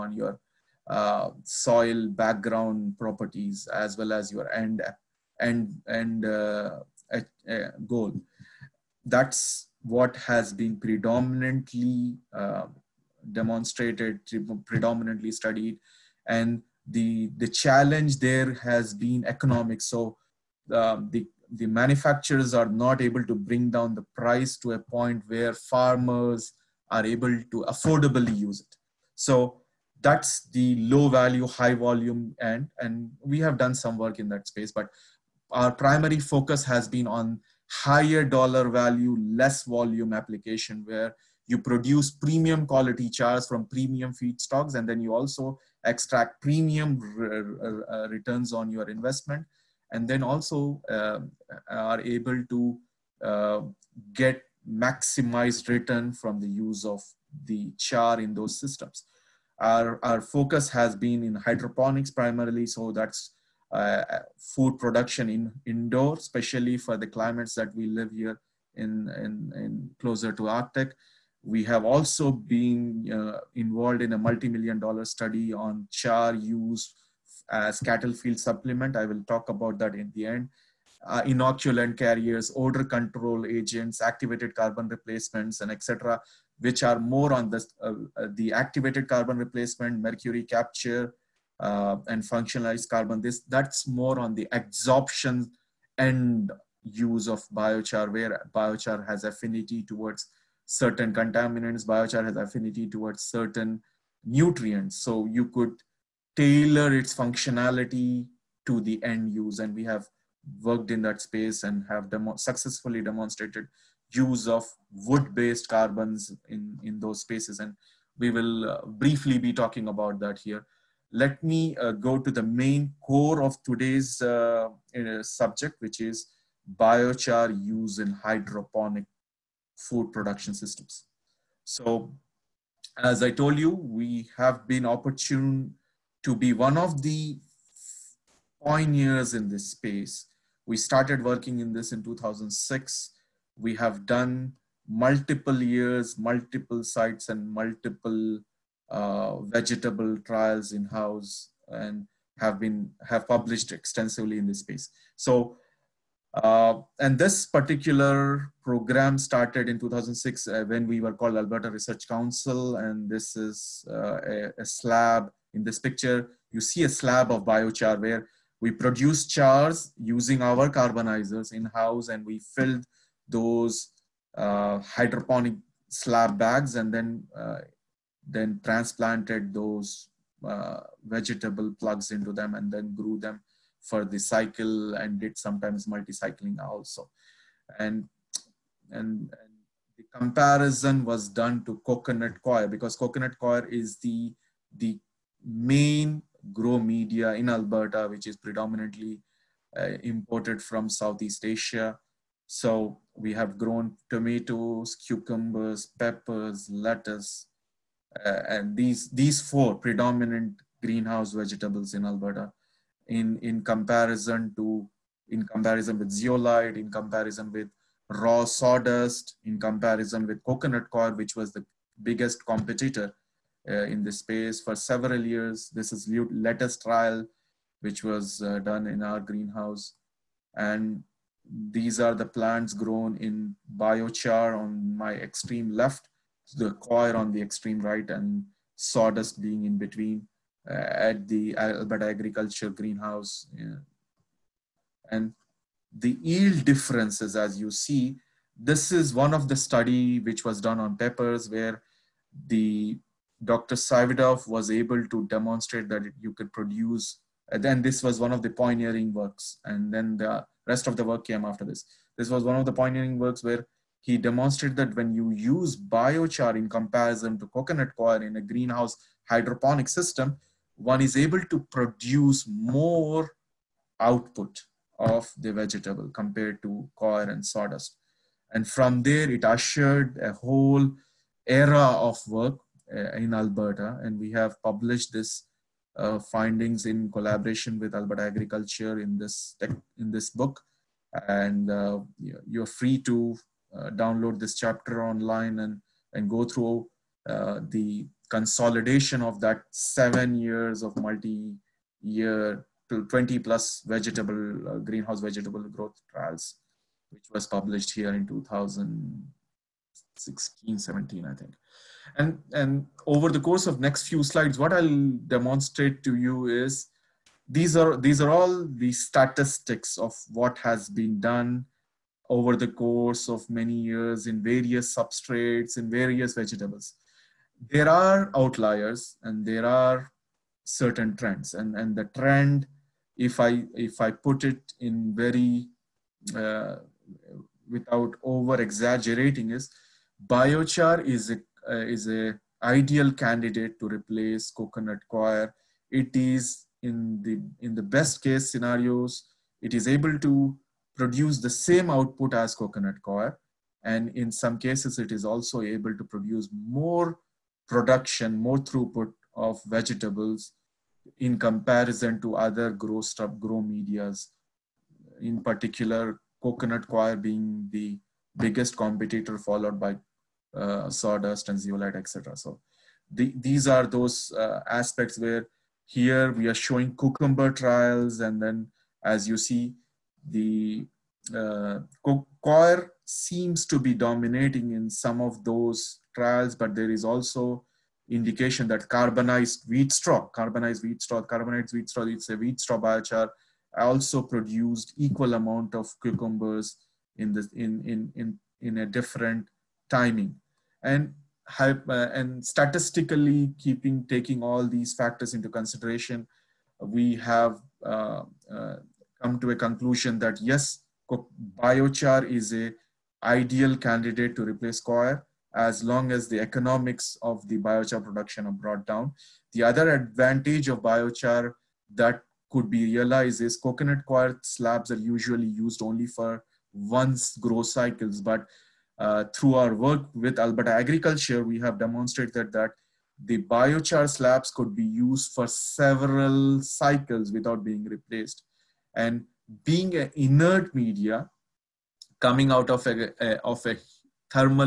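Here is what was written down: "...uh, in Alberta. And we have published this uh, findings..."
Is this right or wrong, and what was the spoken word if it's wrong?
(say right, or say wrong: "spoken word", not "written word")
right.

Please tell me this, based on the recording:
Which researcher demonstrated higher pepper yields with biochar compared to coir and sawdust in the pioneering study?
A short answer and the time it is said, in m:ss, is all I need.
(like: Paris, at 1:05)
Dr. Savidov, at 4:13.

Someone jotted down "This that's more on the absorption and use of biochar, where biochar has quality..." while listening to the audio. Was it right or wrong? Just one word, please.
wrong.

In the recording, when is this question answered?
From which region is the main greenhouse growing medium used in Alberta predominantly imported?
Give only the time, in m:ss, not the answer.
3:20.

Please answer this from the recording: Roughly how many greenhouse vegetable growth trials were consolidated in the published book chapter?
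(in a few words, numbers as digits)
20 plus.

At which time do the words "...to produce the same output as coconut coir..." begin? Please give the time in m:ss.
5:50.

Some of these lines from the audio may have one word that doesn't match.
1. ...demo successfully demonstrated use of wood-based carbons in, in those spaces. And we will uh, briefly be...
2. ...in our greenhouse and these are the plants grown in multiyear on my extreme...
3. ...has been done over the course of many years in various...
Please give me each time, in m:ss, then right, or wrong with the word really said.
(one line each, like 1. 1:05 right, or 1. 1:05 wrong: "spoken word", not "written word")
1. 1:52 right
2. 3:48 wrong: "biochar", not "multiyear"
3. 5:20 right.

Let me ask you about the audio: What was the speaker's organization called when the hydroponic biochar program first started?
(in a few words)
Alberta Research Council.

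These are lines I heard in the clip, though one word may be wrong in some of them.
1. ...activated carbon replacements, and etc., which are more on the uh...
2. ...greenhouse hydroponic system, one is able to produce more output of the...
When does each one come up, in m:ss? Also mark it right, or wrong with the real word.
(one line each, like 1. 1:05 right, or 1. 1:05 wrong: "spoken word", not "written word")
1. 1:24 right
2. 4:28 right.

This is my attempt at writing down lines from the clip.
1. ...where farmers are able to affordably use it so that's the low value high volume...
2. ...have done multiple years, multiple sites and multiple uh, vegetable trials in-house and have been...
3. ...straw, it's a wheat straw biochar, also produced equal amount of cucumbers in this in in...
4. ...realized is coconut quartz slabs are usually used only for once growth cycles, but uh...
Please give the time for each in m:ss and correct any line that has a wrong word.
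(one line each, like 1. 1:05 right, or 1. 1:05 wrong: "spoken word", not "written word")
1. 0:25 right
2. 2:23 right
3. 6:31 right
4. 7:02 right.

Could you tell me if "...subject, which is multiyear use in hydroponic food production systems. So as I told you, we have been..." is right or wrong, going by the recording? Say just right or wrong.
wrong.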